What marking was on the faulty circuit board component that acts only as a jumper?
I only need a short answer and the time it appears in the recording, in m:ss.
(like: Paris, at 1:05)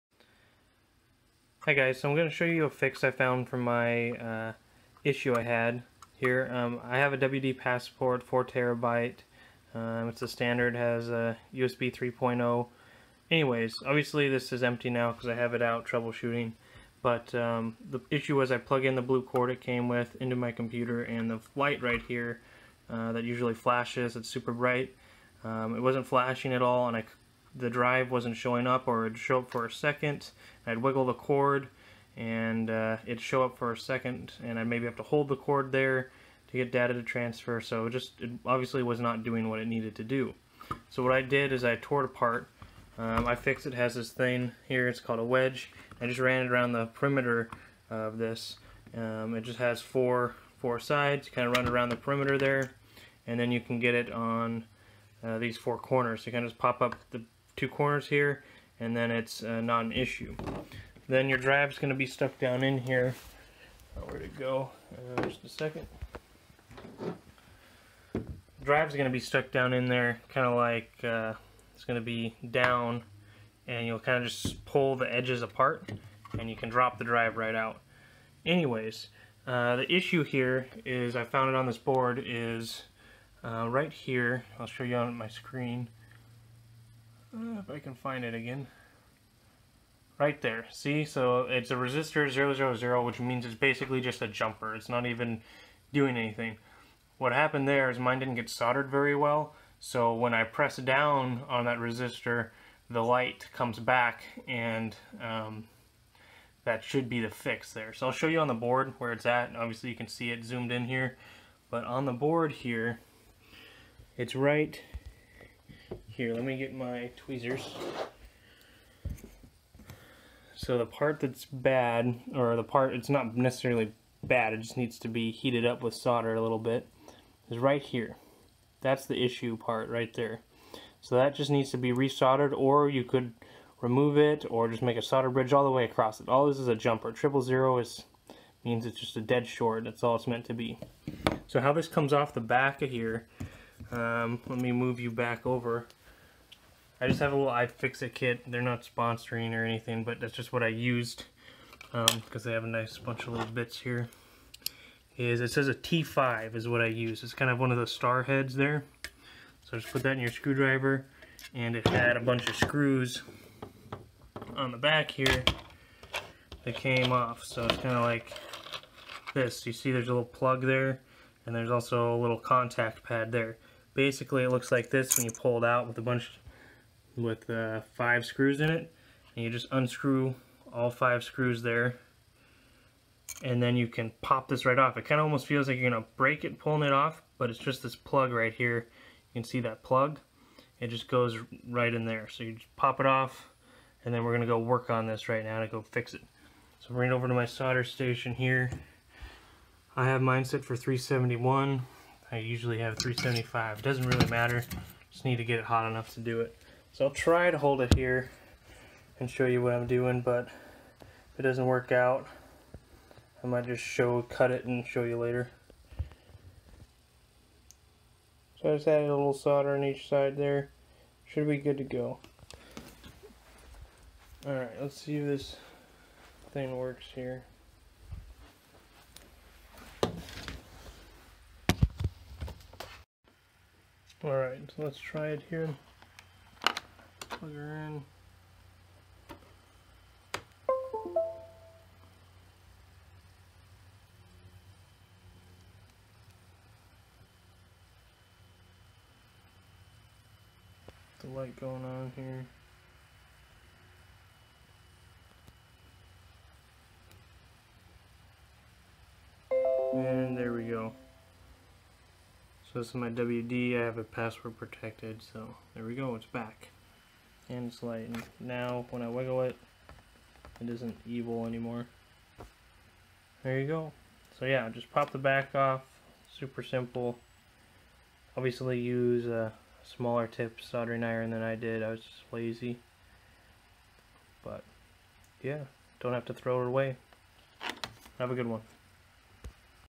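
000, at 1:31.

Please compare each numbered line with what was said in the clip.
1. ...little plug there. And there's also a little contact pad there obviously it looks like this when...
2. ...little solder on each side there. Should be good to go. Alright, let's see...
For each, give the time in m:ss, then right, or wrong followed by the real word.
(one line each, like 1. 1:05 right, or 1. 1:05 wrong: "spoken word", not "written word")
1. 2:50 wrong: "basically", not "obviously"
2. 3:39 right.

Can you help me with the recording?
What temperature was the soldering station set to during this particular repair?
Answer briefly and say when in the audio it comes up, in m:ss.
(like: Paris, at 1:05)
371, at 3:20.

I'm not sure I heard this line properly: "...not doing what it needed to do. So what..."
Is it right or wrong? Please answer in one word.
right.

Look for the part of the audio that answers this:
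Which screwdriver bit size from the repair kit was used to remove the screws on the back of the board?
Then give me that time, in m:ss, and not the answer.
2:35.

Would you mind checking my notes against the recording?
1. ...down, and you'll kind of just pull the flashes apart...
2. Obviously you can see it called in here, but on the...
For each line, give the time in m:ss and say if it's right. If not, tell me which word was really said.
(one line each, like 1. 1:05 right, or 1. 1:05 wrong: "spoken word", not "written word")
1. 1:12 wrong: "edges", not "flashes"
2. 1:49 wrong: "zoomed", not "called".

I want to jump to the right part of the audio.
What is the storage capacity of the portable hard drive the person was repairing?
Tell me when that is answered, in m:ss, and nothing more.
0:08.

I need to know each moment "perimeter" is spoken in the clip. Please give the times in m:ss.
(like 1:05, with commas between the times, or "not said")
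0:46, 0:51.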